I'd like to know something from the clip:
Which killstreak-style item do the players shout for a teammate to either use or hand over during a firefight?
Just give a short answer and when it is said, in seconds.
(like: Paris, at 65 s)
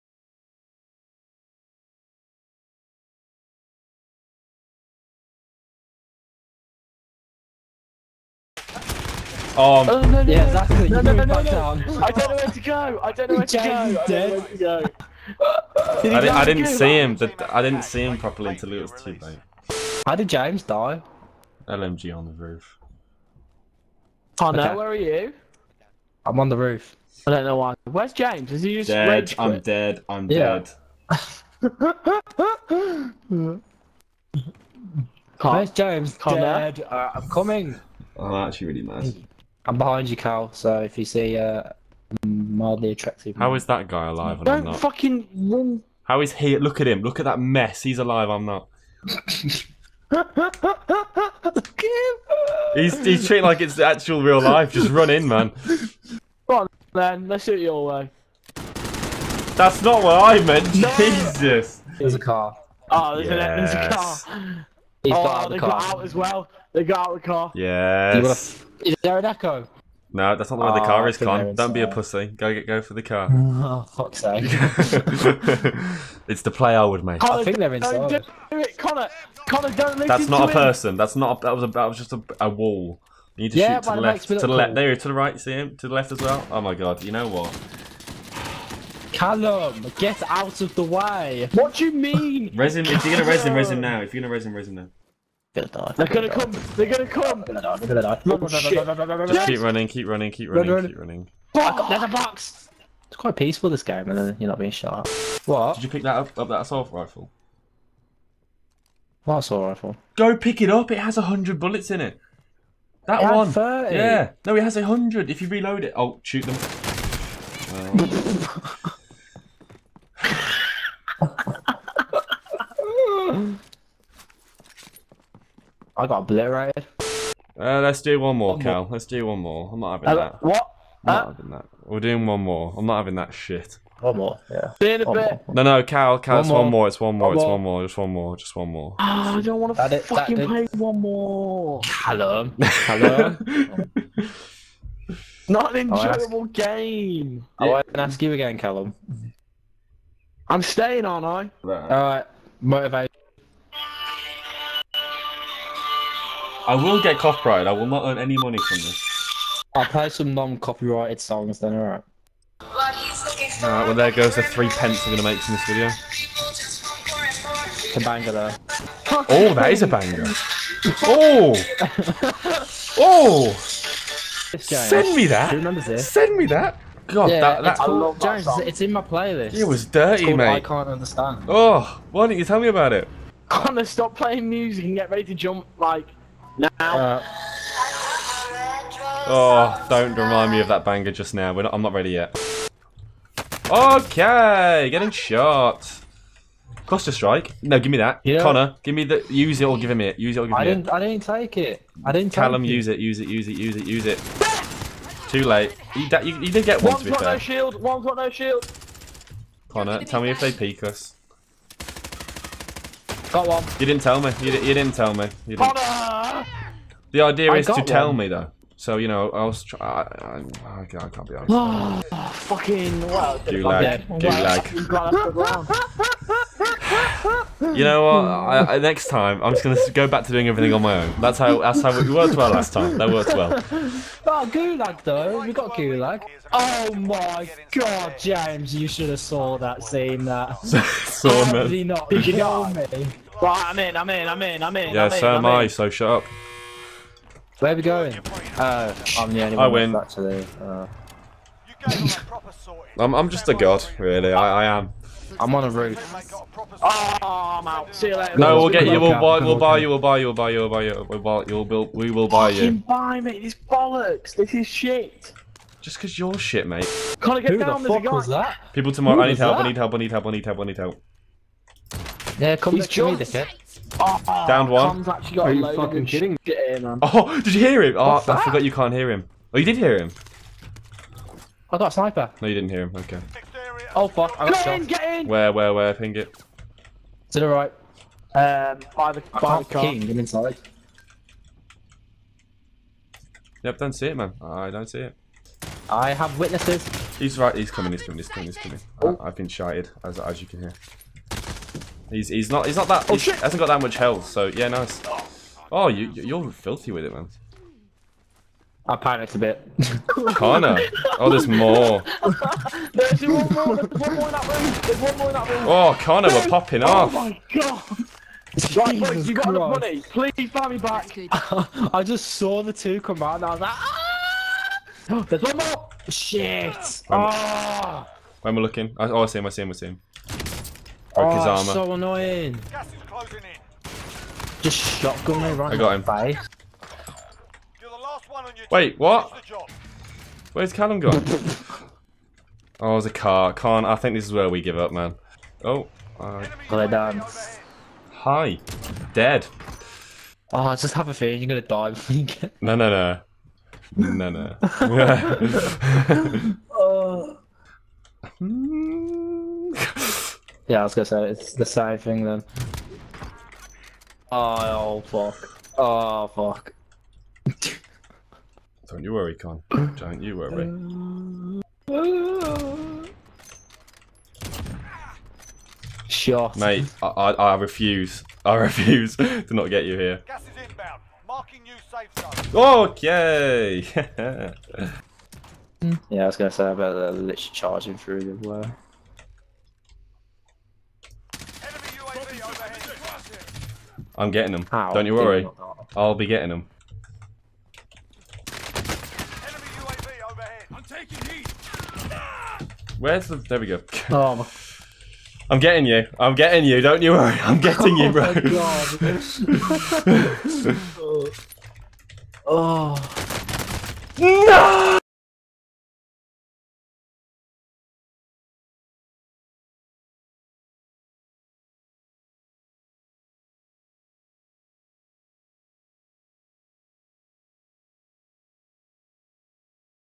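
Cluster strike, at 196 s.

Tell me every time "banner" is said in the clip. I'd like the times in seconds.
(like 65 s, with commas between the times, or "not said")
not said.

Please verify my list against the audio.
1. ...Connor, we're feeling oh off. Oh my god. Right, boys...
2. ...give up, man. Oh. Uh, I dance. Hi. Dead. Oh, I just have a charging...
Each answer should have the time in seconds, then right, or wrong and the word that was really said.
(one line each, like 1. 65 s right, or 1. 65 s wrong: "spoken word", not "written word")
1. 316 s wrong: "popping", not "feeling"
2. 344 s wrong: "feeling", not "charging".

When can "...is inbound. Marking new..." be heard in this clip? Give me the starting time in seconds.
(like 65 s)
380 s.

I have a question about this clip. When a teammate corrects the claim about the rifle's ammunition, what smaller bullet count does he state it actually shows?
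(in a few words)
30.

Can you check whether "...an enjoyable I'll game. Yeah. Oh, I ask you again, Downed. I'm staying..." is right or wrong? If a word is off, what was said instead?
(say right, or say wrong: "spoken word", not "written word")
wrong: "Callum", not "Downed".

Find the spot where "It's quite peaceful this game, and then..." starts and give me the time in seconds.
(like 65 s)
103 s.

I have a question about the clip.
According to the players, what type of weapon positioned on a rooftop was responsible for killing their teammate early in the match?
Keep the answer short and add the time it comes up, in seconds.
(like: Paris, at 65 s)
LMG, at 21 s.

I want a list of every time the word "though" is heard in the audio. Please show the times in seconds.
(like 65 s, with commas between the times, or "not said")
218 s, 235 s.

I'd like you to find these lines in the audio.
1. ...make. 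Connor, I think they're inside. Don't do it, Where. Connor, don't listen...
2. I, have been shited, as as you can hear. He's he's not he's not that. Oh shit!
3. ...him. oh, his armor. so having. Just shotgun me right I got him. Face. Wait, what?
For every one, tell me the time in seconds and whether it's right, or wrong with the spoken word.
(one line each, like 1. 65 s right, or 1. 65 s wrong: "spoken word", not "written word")
1. 77 s wrong: "Connor", not "Where"
2. 299 s right
3. 329 s wrong: "annoying", not "having".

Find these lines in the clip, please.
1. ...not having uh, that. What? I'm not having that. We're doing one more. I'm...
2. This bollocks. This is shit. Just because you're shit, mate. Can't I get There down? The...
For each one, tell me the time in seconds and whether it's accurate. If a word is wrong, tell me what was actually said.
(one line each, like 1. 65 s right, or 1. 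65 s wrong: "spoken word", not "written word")
1. 129 s right
2. 263 s wrong: "Who", not "There".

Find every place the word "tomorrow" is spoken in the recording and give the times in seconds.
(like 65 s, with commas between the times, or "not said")
268 s.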